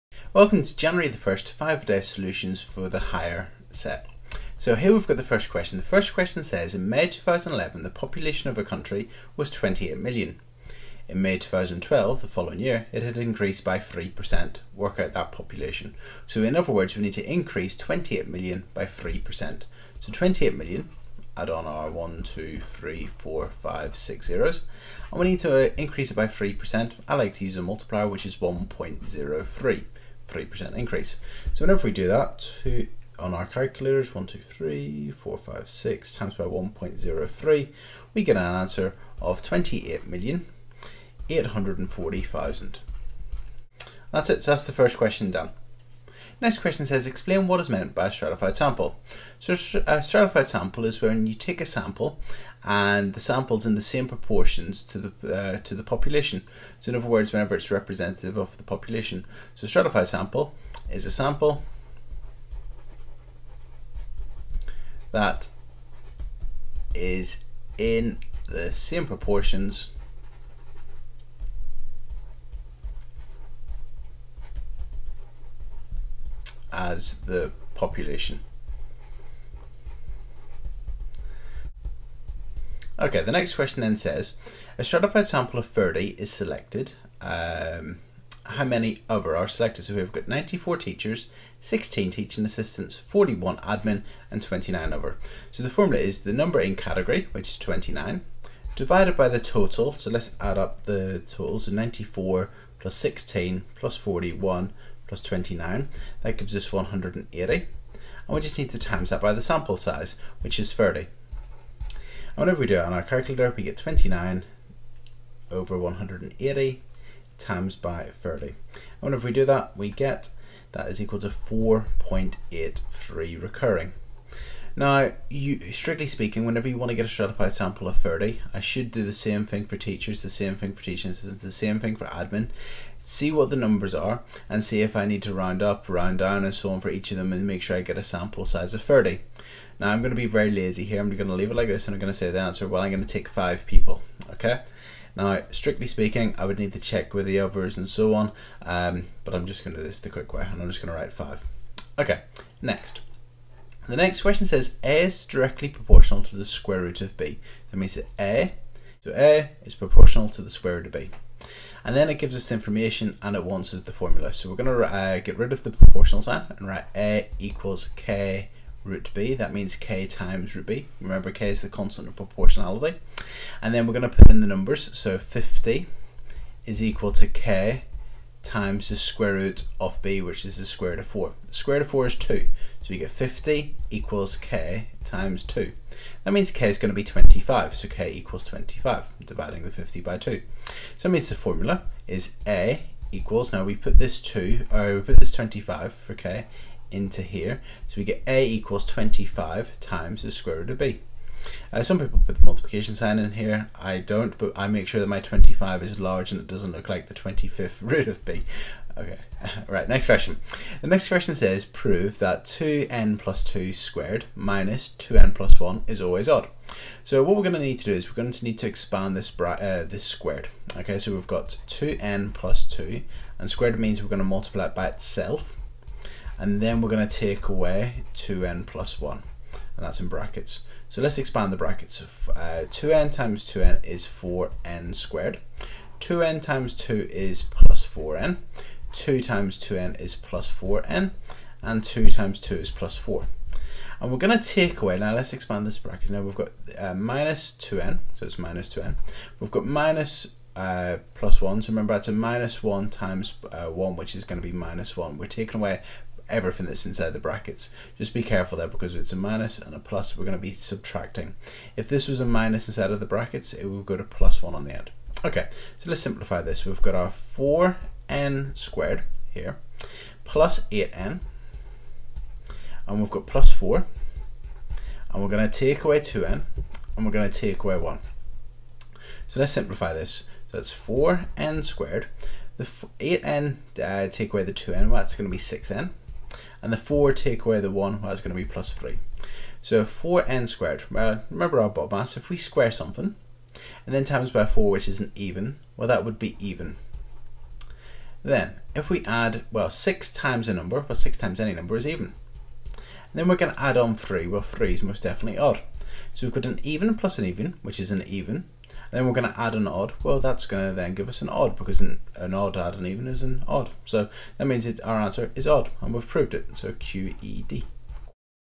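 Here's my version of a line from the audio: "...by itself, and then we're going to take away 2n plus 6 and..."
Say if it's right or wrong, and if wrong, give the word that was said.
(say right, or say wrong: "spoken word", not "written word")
wrong: "1", not "6".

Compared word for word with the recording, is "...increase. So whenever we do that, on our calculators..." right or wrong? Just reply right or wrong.
right.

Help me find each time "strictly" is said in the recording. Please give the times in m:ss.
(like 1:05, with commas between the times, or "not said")
2:05, 2:25.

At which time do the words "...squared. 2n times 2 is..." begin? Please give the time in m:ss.
3:54.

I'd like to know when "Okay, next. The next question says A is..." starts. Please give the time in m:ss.
2:31.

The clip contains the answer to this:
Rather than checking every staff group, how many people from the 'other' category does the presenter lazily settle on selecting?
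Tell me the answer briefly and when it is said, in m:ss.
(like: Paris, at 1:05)
5, at 2:23.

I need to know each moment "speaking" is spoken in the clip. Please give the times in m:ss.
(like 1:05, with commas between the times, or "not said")
2:06, 2:25.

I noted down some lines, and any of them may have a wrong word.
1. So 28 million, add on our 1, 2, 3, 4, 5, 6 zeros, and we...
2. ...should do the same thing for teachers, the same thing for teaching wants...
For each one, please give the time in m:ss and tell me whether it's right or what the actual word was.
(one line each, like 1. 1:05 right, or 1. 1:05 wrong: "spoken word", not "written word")
1. 0:19 right
2. 2:08 wrong: "assistants", not "wants".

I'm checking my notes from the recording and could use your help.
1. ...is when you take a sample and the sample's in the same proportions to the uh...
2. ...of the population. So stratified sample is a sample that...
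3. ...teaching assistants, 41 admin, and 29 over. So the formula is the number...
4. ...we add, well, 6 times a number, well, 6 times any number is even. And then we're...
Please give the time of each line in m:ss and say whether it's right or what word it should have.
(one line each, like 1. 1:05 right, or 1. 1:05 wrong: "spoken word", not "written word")
1. 0:50 right
2. 0:58 right
3. 1:32 right
4. 4:58 right.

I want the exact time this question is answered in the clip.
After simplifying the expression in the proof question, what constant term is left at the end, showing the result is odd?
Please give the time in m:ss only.
4:48.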